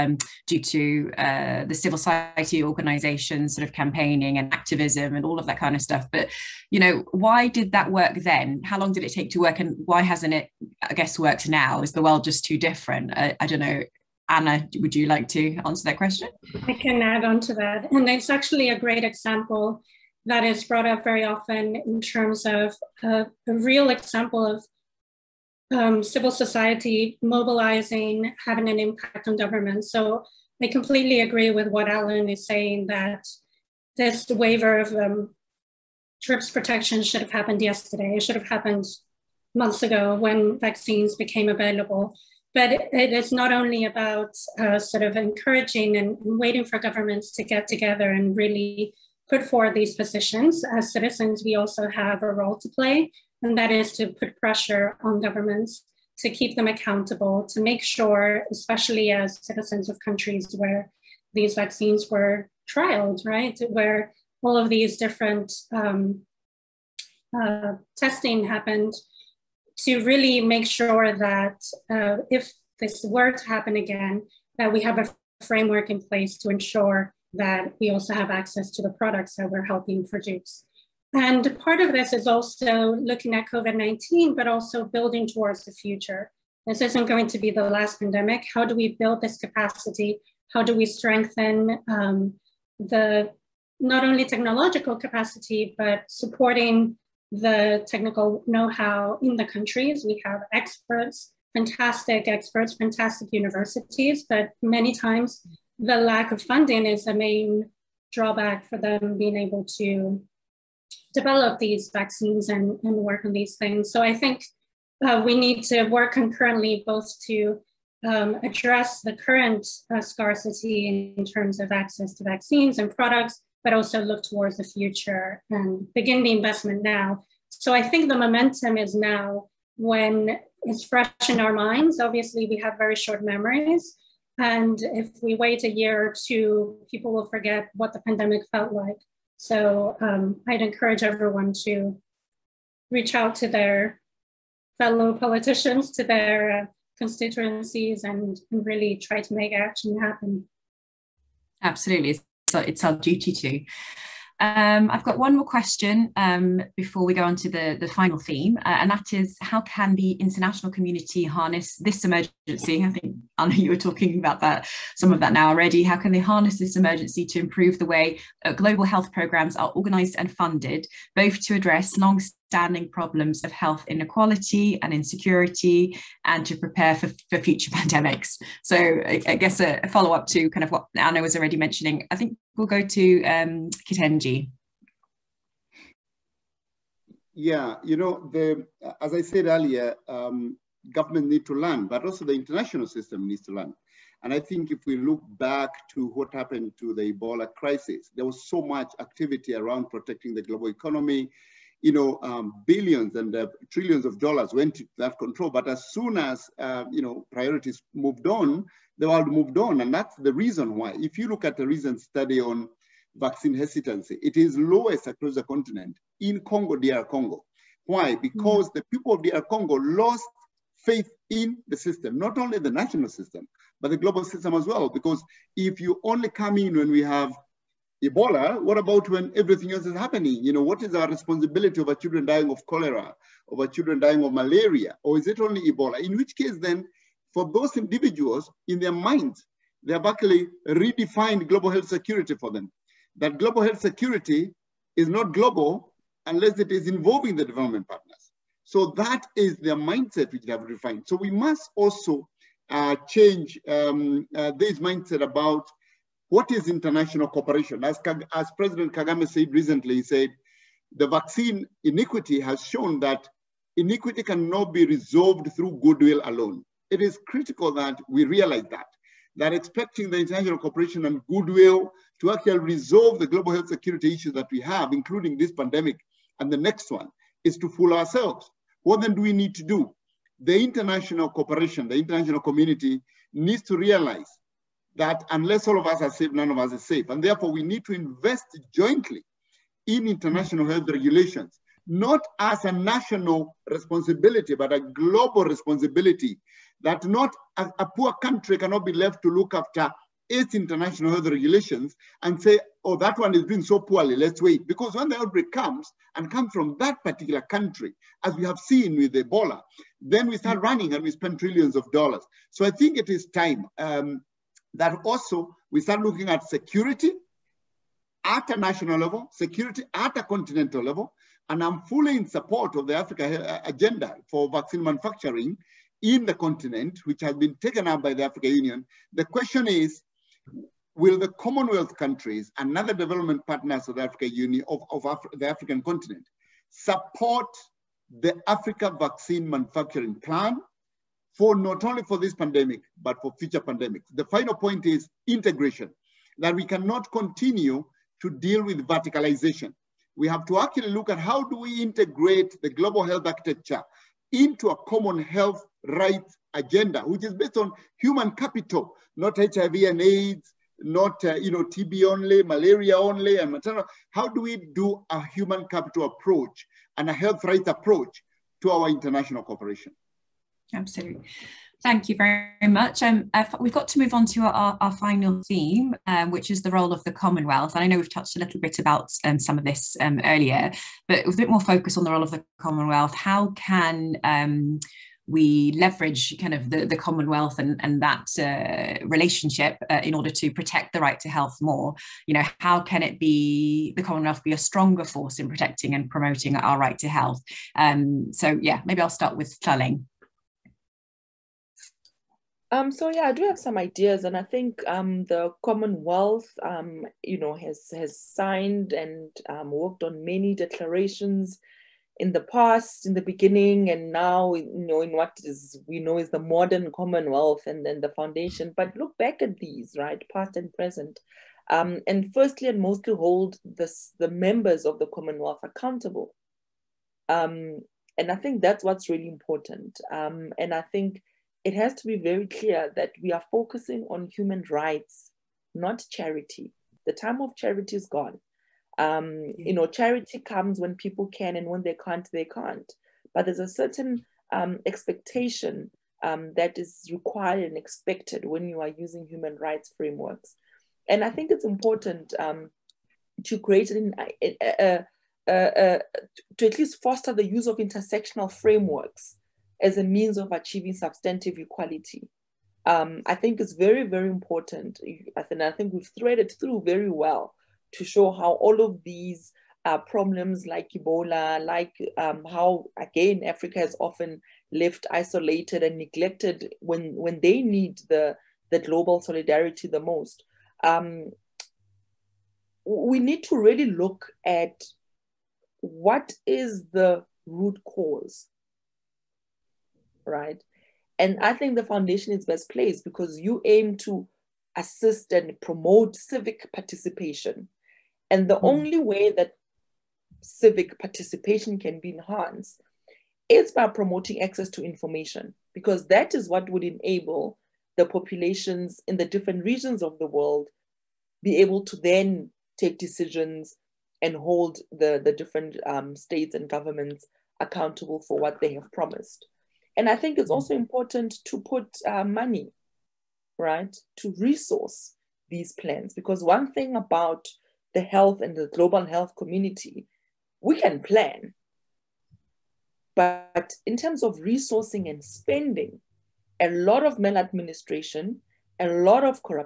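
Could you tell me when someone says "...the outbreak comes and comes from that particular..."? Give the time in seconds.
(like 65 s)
305 s.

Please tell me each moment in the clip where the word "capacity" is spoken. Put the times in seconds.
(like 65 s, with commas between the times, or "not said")
89 s, 94 s.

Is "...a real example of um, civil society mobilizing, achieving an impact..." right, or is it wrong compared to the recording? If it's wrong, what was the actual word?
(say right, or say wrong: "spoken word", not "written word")
wrong: "having", not "achieving".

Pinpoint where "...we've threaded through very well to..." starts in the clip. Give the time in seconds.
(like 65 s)
465 s.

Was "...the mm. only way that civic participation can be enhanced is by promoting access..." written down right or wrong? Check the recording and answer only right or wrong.
right.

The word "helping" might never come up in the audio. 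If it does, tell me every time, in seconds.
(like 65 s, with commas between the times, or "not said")
79 s.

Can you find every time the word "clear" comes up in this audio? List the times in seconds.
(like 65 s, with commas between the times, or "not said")
432 s.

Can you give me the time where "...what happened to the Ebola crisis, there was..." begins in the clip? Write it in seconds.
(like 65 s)
196 s.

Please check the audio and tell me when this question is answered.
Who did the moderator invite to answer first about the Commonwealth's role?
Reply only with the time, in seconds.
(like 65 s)
399 s.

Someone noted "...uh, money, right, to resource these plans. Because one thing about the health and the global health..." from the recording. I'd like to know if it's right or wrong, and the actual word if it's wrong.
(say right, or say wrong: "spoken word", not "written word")
right.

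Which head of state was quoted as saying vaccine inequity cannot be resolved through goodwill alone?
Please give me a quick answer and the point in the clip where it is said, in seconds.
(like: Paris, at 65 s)
President Kagame, at 258 s.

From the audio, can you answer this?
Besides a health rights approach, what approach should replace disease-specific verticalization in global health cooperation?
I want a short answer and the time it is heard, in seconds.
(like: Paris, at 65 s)
human capital approach, at 365 s.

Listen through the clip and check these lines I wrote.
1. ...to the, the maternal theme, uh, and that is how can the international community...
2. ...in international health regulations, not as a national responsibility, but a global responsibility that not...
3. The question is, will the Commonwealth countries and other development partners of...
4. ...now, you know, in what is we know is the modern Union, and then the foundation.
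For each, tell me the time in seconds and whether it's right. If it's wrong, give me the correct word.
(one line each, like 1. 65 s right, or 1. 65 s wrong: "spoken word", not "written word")
1. 157 s wrong: "final", not "maternal"
2. 289 s right
3. 329 s right
4. 414 s wrong: "Commonwealth", not "Union".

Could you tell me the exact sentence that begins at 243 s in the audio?
That global health security is not global unless it is involving the development partners.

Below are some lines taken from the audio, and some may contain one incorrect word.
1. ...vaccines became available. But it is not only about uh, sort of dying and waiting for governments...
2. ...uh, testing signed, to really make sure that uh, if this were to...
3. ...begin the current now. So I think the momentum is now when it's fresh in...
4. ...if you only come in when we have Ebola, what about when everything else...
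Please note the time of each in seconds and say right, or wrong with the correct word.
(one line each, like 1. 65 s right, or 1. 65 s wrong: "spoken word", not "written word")
1. 40 s wrong: "encouraging", not "dying"
2. 67 s wrong: "happened", not "signed"
3. 125 s wrong: "investment", not "current"
4. 225 s right.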